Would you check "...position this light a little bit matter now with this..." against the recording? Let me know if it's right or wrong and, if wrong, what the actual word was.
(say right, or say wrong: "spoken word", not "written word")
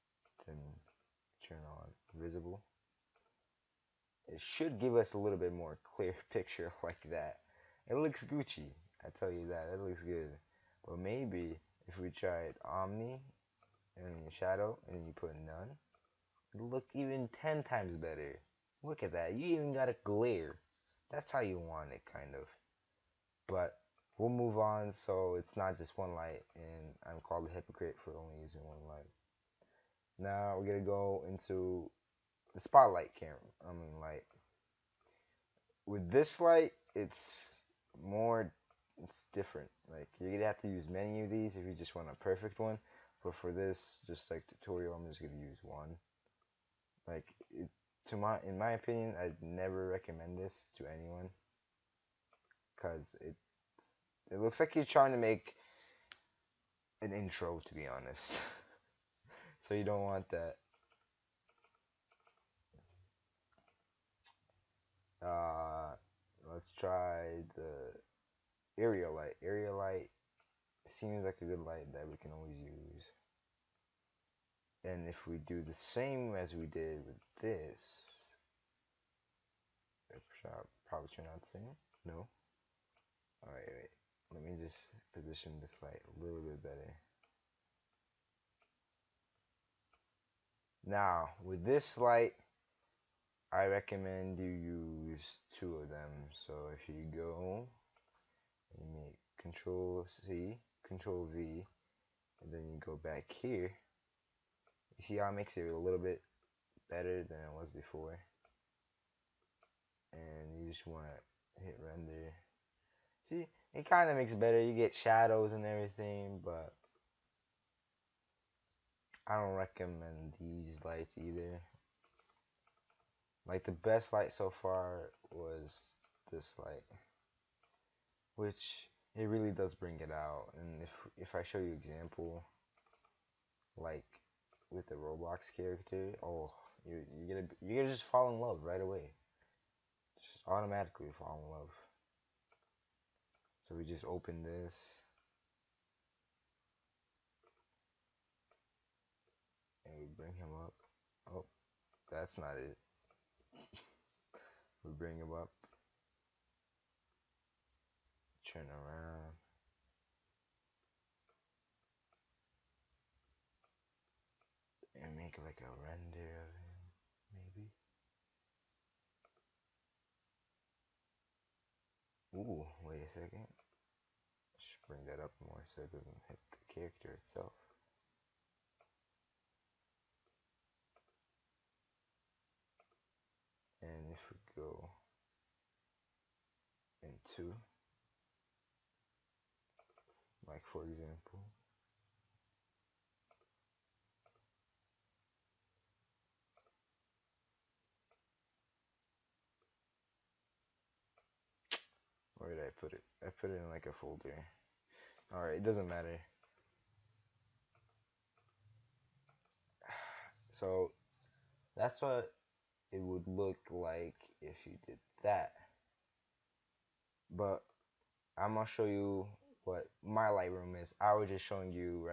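wrong: "better", not "matter".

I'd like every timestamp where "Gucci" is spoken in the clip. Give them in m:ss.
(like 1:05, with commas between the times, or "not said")
0:08.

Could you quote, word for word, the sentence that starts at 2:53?
I should bring that up more so it doesn't hit the character itself.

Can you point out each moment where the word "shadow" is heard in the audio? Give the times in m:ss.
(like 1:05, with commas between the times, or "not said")
0:14, 1:54.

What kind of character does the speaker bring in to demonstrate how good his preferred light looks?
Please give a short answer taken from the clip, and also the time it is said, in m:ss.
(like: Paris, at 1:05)
Roblox character, at 2:14.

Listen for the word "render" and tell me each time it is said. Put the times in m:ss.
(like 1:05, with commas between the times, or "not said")
1:51, 2:45.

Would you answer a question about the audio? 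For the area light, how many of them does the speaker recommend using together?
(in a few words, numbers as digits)
2.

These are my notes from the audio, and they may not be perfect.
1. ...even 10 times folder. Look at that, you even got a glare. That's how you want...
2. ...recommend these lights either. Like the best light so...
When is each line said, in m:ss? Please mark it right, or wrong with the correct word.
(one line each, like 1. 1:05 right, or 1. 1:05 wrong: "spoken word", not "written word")
1. 0:16 wrong: "better", not "folder"
2. 1:59 right.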